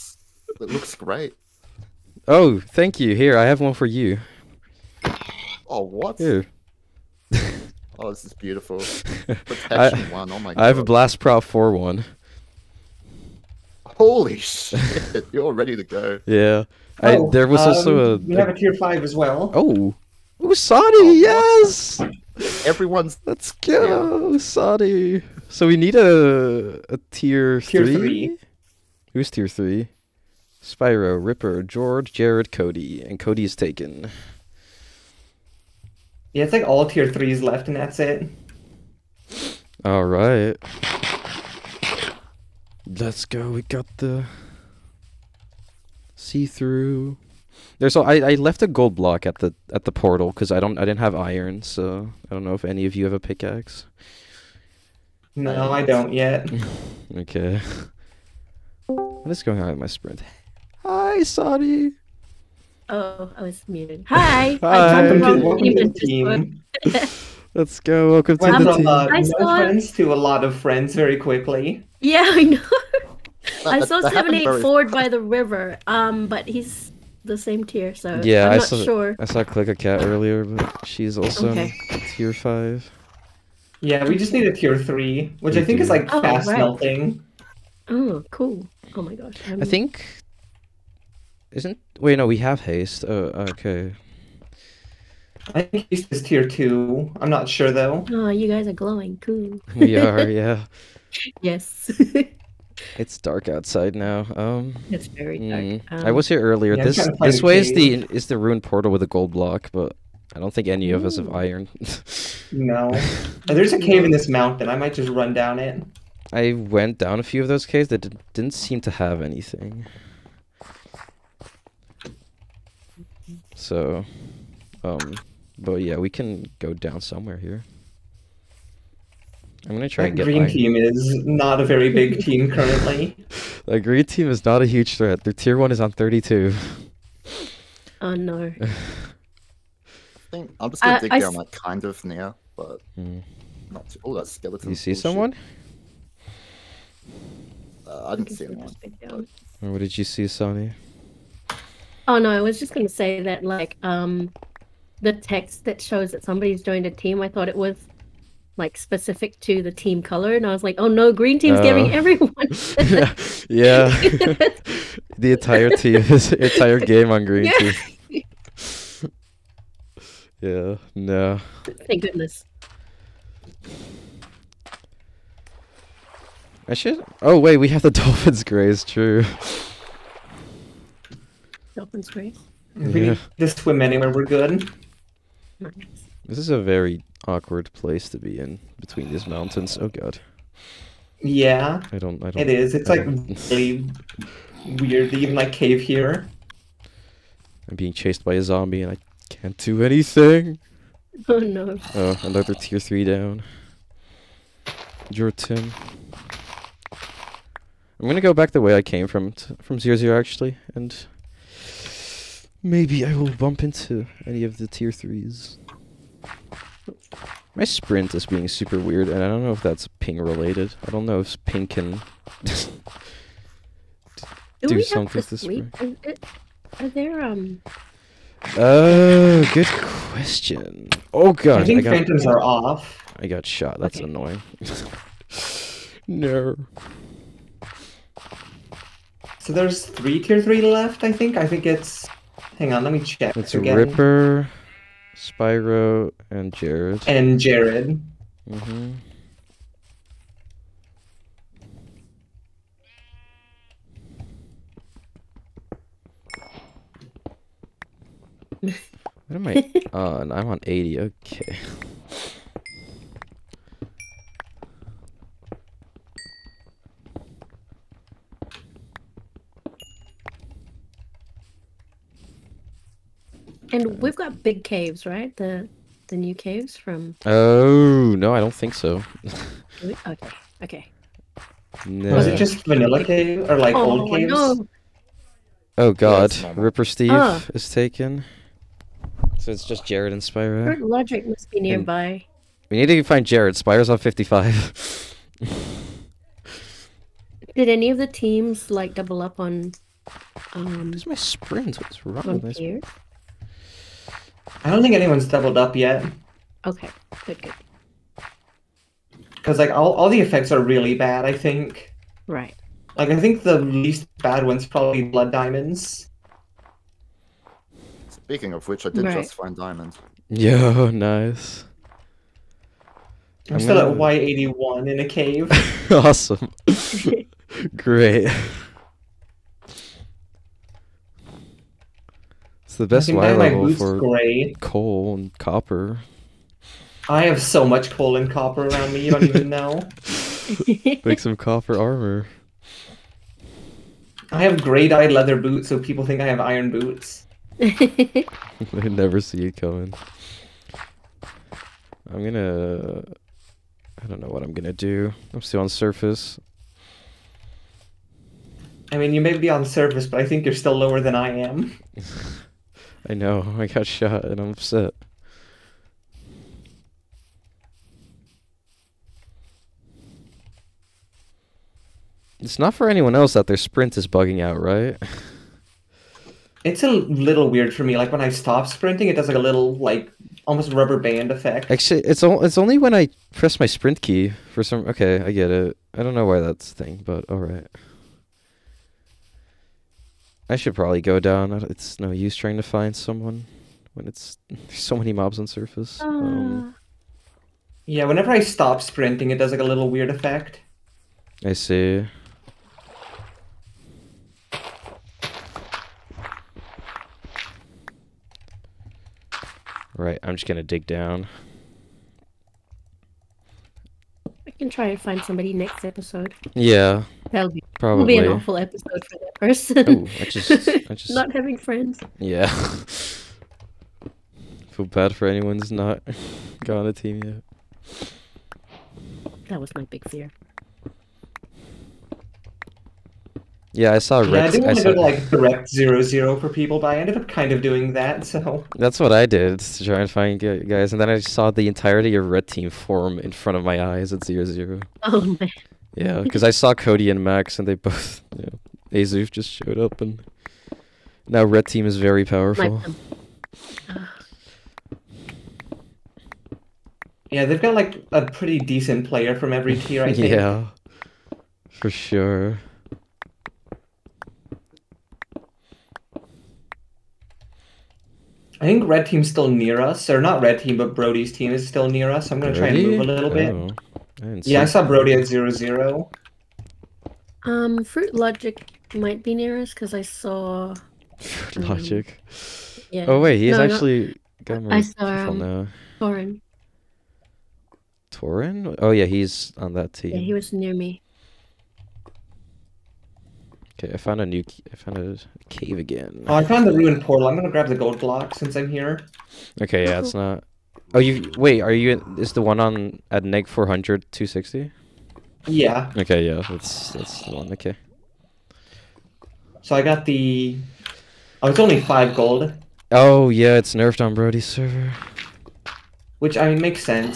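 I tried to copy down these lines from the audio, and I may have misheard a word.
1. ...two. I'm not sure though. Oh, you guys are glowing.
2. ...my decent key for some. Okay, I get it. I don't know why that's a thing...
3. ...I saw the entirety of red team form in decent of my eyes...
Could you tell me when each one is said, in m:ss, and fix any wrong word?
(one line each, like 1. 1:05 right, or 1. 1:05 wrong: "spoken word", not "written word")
1. 1:36 right
2. 6:23 wrong: "sprint", not "decent"
3. 7:21 wrong: "front", not "decent".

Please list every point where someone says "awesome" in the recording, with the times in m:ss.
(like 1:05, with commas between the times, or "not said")
5:25.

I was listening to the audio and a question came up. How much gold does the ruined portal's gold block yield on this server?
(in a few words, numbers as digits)
5.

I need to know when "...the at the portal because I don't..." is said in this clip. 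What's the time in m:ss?
0:49.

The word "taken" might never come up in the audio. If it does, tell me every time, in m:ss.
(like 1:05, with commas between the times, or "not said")
0:33, 4:47.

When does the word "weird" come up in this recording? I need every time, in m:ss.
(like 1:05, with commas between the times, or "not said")
3:14, 3:38, 6:17, 6:39.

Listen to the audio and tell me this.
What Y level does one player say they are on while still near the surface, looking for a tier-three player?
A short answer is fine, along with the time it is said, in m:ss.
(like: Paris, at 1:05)
80, at 4:20.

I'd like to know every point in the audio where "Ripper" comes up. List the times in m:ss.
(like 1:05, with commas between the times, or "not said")
0:31, 4:03, 4:46.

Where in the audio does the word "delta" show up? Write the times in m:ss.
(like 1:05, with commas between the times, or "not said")
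not said.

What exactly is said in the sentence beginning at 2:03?
So, um, but yeah, we can go down somewhere here.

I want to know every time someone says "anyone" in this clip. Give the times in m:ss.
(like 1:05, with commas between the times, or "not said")
2:28, 5:04, 6:12, 7:05.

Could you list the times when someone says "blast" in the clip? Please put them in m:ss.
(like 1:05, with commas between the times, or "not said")
0:10.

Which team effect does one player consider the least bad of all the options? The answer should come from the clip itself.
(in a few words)
Blood diamonds.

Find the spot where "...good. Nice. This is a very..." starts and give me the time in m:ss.
3:04.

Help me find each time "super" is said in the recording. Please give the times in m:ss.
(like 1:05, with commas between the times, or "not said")
3:38.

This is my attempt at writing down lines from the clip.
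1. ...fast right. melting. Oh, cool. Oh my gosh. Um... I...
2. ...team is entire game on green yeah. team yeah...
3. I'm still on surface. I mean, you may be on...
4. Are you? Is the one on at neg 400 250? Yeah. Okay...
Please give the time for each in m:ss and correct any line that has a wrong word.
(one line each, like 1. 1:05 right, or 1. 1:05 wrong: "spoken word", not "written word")
1. 1:26 right
2. 2:45 right
3. 5:55 right
4. 8:21 wrong: "260", not "250".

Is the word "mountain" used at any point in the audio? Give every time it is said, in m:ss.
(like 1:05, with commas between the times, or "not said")
1:54, 3:09.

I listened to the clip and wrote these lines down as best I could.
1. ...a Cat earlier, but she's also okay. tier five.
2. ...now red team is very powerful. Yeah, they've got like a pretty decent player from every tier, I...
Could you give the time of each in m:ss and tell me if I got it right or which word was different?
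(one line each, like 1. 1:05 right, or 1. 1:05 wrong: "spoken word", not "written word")
1. 1:19 right
2. 7:31 right.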